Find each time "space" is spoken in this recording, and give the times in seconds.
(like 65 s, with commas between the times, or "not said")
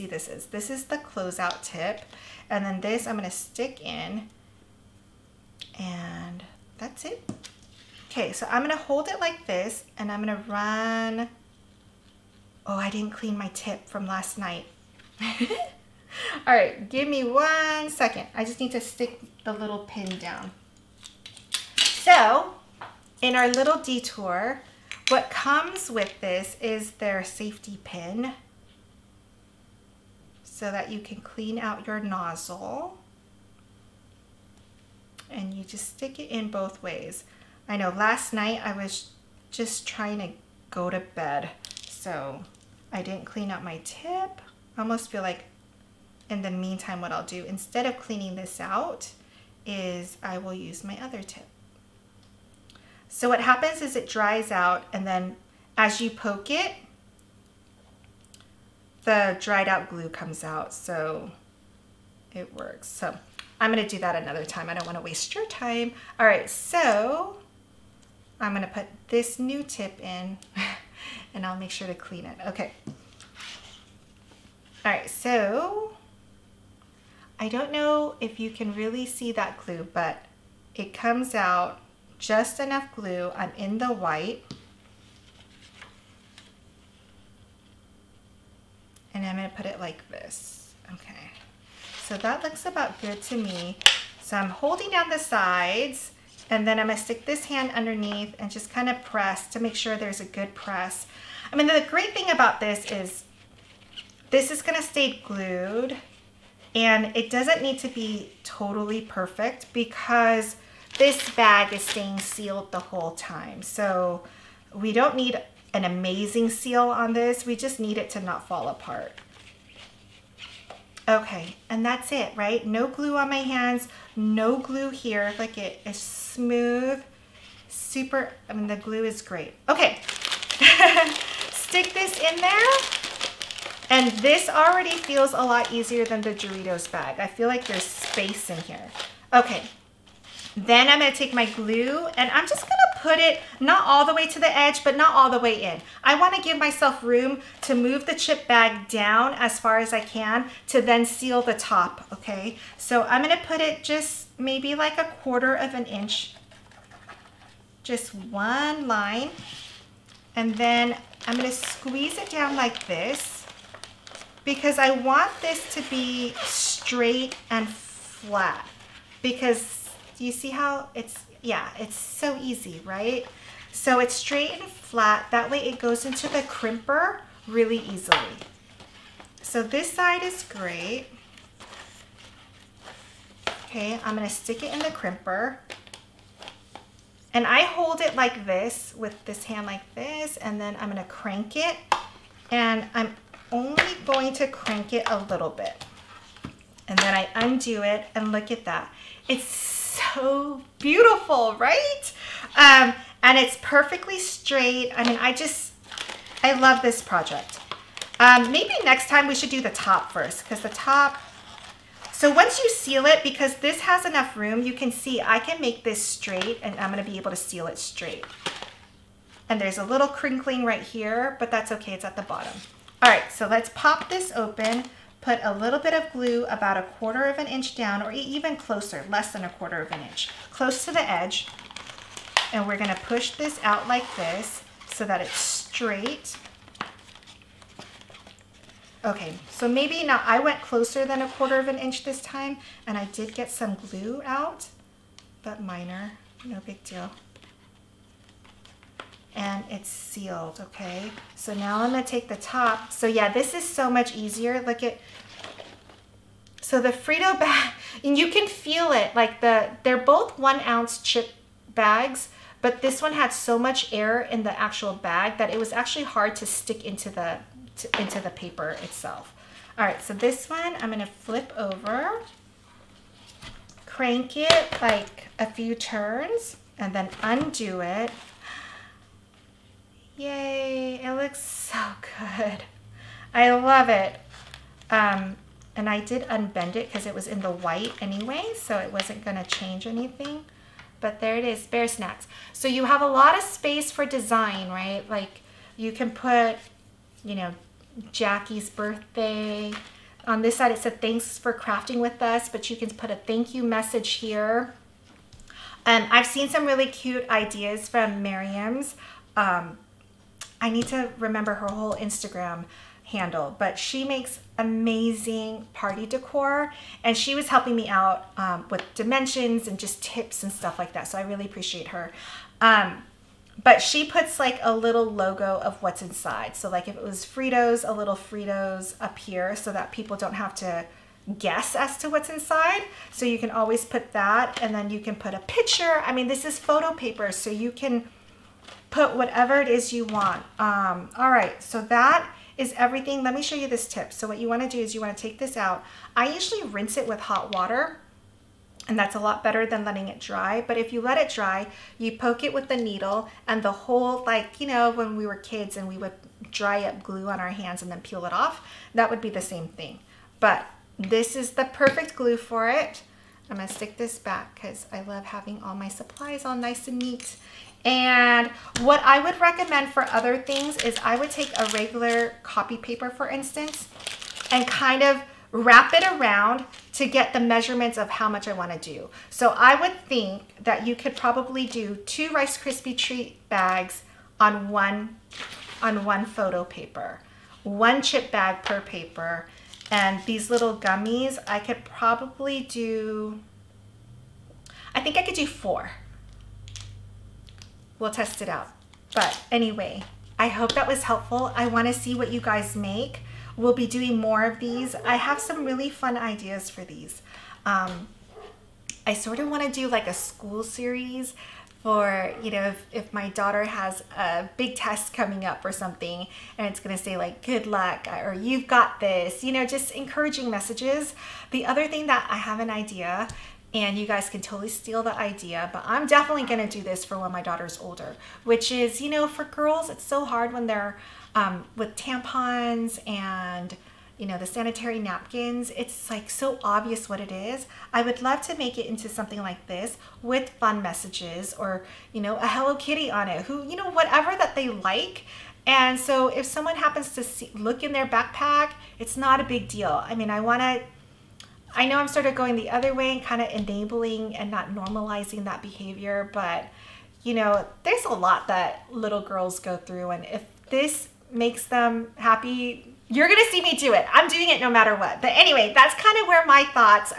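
137 s, 293 s.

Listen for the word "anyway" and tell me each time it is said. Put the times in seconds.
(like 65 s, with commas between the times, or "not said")
288 s, 399 s, 465 s.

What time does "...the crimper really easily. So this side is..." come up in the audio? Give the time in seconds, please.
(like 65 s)
176 s.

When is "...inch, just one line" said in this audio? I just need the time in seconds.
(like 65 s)
155 s.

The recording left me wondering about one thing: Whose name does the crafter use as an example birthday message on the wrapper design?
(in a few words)
Jackie.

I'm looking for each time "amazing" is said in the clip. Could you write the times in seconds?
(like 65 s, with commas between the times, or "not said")
115 s, 314 s.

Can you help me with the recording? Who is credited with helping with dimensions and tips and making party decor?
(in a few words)
Miriam.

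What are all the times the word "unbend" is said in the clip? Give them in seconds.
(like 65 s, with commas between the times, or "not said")
286 s.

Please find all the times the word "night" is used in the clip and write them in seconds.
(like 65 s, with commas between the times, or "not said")
14 s, 38 s.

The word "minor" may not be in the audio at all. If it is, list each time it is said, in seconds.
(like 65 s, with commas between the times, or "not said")
245 s.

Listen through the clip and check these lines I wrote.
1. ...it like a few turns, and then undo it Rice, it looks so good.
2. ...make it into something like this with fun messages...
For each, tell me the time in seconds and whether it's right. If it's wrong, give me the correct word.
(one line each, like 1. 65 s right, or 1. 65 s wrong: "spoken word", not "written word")
1. 274 s wrong: "Yay", not "Rice"
2. 438 s right.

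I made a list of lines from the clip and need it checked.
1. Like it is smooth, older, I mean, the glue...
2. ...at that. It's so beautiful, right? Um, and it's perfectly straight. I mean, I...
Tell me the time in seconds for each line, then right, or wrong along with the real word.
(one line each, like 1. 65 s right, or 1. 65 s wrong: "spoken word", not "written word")
1. 125 s wrong: "super", not "older"
2. 198 s right.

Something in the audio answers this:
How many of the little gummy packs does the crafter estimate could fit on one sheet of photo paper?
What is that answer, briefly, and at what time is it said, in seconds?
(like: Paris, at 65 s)
4, at 395 s.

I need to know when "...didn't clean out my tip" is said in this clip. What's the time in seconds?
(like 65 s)
43 s.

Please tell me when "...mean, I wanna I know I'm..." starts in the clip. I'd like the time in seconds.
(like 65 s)
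450 s.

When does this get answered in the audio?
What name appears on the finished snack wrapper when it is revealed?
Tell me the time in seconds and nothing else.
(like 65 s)
291 s.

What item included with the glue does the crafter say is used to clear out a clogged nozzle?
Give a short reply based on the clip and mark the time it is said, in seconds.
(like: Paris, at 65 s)
safety pin, at 27 s.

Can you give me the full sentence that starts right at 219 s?
And there's a little crinkling right here, but that's okay, it's at the bottom.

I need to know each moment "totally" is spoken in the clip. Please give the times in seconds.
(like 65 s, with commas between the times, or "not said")
108 s, 424 s.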